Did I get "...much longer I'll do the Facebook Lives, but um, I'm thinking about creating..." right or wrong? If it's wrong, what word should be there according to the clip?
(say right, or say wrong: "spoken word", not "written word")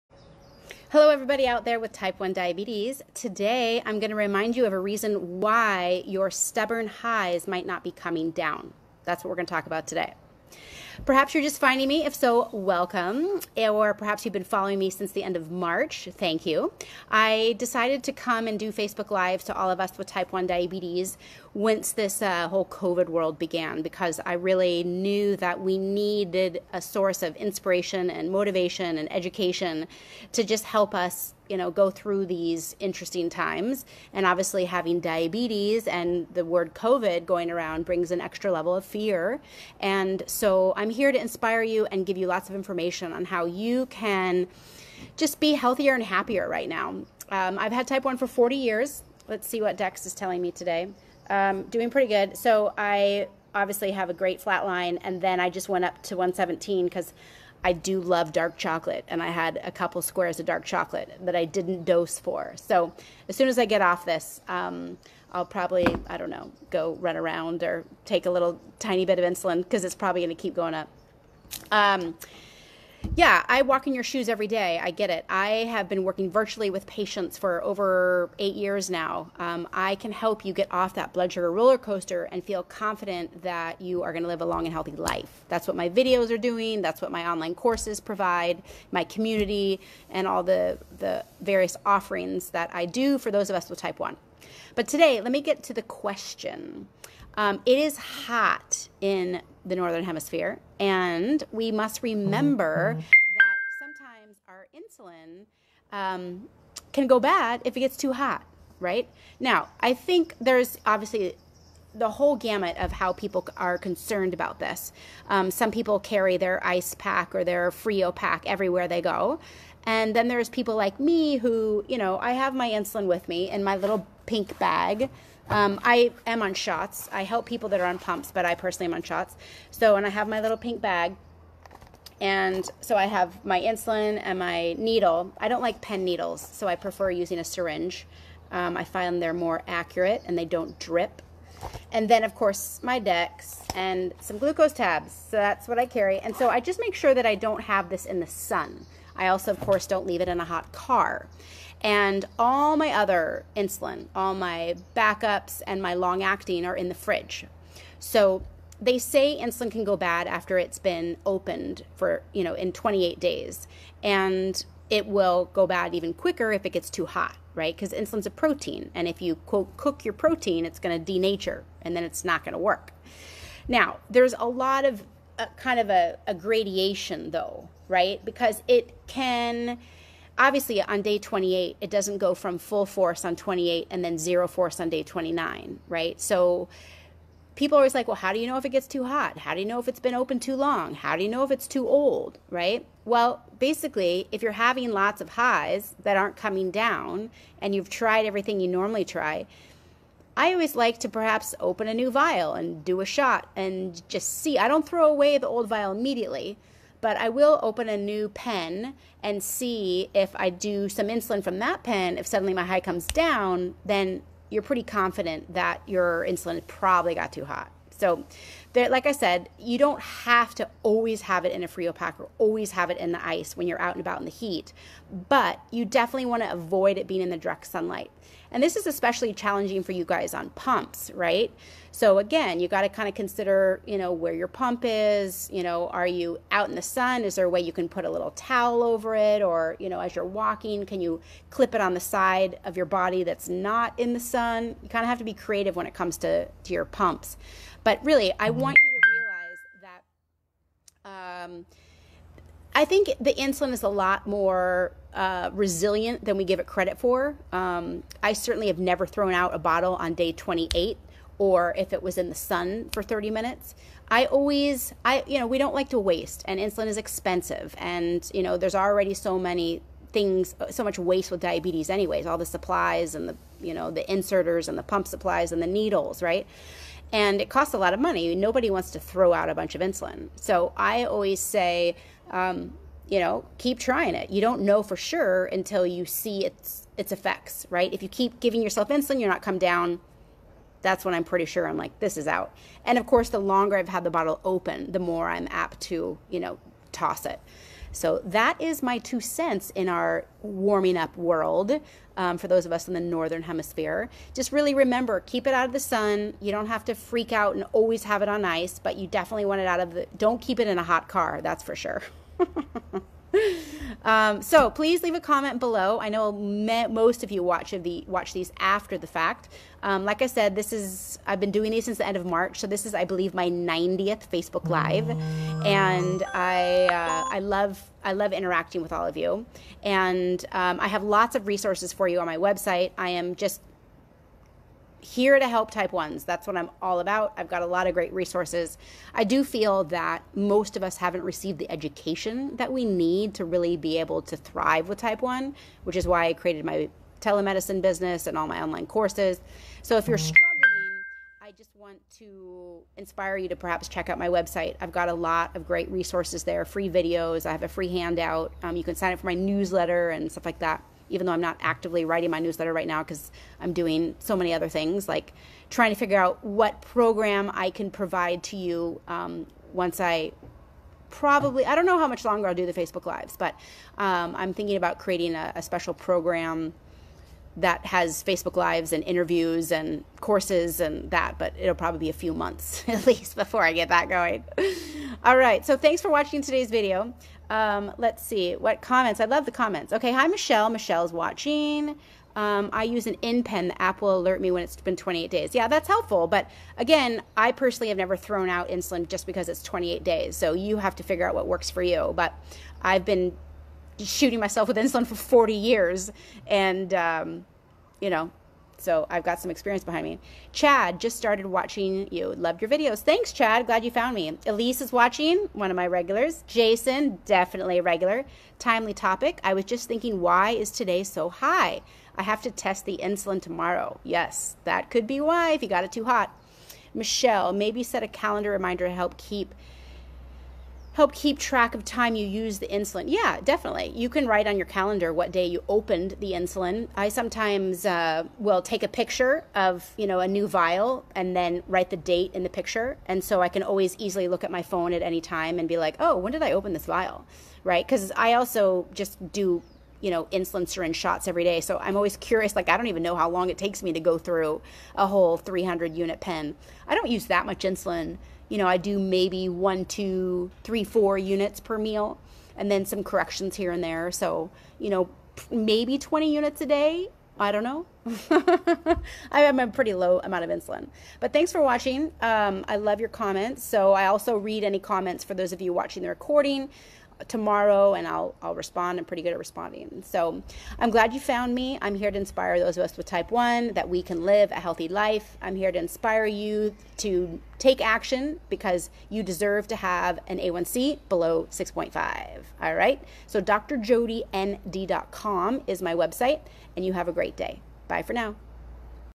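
right.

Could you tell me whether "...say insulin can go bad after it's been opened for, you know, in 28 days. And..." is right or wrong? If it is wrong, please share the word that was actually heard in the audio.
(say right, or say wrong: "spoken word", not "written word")
right.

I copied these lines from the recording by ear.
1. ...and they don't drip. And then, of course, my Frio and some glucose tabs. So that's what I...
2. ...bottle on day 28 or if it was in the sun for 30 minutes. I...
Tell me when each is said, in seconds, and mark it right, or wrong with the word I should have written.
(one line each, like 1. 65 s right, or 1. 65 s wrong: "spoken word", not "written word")
1. 140 s wrong: "Dex", not "Frio"
2. 259 s right.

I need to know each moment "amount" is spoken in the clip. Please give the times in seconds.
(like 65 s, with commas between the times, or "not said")
470 s.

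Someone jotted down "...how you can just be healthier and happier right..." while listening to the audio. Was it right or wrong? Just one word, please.
right.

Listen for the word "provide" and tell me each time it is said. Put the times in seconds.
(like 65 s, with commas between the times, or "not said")
87 s, 367 s.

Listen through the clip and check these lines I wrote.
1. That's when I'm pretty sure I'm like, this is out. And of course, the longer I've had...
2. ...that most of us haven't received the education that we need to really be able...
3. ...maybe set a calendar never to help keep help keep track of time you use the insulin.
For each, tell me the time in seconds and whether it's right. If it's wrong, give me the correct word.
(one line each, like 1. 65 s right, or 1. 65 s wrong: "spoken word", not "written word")
1. 290 s right
2. 339 s right
3. 427 s wrong: "reminder", not "never".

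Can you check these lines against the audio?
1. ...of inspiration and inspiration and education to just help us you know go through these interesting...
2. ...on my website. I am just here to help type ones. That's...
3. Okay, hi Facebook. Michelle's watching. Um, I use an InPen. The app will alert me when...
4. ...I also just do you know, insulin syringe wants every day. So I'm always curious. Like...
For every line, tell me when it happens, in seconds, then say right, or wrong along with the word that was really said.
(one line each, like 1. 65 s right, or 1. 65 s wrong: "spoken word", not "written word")
1. 27 s wrong: "motivation", not "inspiration"
2. 332 s right
3. 389 s wrong: "Michelle", not "Facebook"
4. 448 s wrong: "shots", not "wants".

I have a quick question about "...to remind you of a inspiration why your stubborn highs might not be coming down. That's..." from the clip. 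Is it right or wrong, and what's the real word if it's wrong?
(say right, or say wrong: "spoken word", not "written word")
wrong: "reason", not "inspiration".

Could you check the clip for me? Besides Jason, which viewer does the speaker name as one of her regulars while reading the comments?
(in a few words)
Elise.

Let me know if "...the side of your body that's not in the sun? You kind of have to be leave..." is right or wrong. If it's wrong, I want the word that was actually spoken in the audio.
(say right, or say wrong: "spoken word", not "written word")
wrong: "creative", not "leave".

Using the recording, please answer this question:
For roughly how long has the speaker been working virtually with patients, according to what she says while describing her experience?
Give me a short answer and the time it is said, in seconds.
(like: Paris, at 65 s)
over 8 years, at 77 s.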